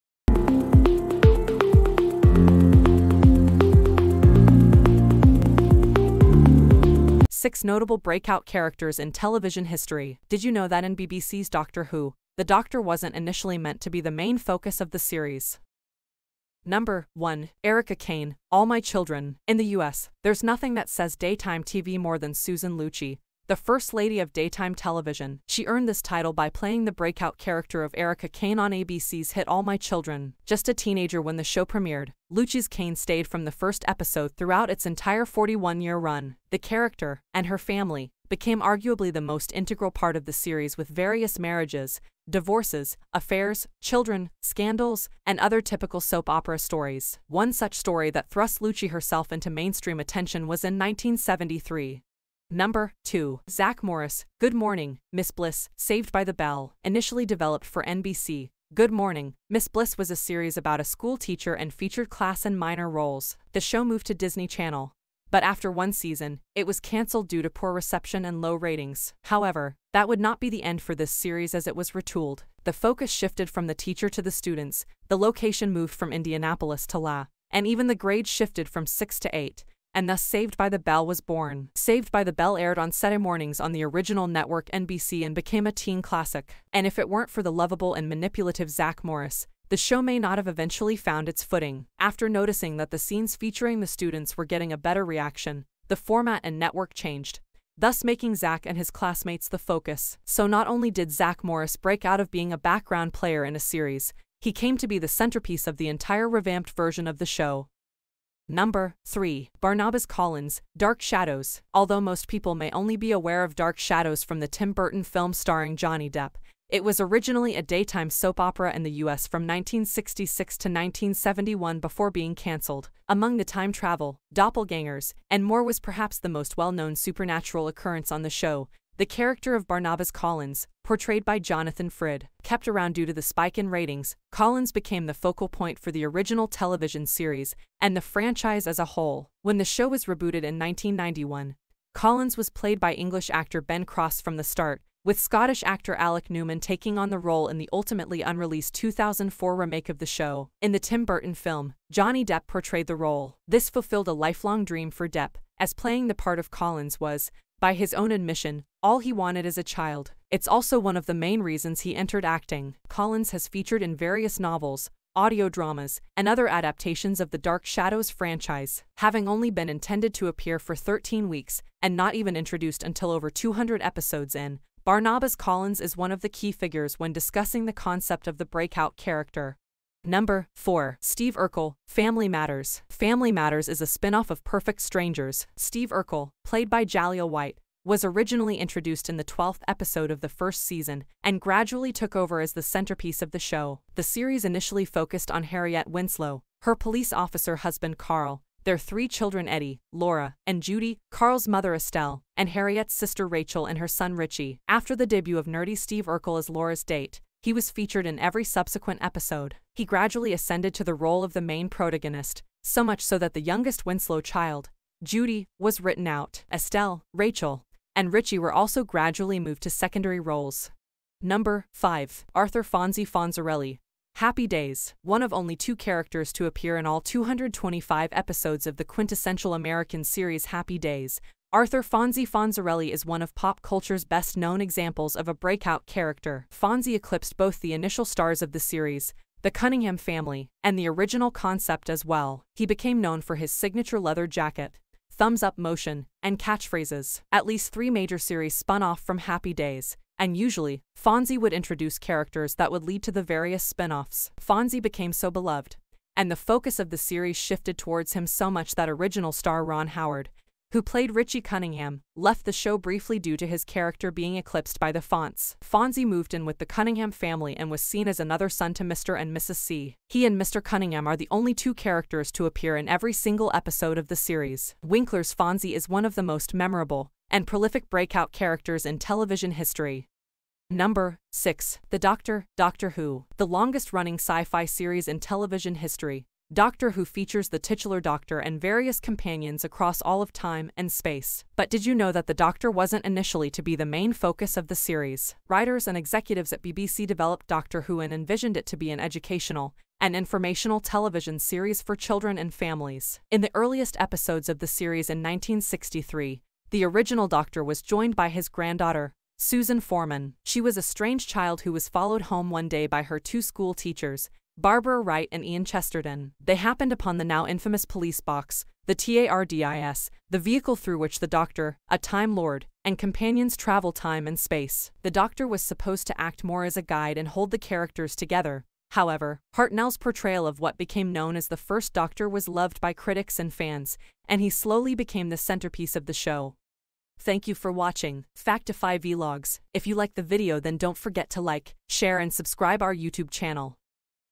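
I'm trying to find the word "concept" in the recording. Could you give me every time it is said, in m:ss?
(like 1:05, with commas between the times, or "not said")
2:57, 4:01.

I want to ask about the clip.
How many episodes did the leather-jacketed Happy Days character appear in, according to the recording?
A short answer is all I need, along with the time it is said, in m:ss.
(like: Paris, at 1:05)
225, at 3:47.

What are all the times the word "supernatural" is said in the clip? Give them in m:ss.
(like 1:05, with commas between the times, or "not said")
2:06.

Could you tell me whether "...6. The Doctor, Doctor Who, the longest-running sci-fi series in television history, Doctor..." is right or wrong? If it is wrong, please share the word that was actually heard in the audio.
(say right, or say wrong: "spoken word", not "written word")
right.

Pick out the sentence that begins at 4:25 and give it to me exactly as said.
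Fonzie moved in with the Cunningham family and was seen as another son to Mr.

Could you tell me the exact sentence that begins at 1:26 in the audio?
And if it weren't for the lovable and manipulative Zach Morris, the show may not have eventually found its footing.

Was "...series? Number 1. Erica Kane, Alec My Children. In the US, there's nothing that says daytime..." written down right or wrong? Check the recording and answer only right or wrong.
wrong.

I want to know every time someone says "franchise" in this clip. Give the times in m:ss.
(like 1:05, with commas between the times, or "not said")
2:17, 2:48.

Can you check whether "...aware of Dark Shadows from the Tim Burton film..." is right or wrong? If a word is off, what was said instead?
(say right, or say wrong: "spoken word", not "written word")
right.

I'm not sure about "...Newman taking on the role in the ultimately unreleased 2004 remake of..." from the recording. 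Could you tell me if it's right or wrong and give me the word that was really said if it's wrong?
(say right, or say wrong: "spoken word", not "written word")
right.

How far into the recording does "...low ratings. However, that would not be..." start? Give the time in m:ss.
1:08.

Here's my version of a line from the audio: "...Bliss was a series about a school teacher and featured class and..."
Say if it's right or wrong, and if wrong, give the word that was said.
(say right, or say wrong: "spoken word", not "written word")
right.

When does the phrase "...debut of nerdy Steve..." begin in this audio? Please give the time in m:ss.
3:25.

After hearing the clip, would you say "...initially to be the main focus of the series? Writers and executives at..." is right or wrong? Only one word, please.
right.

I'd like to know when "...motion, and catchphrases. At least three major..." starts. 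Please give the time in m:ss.
4:05.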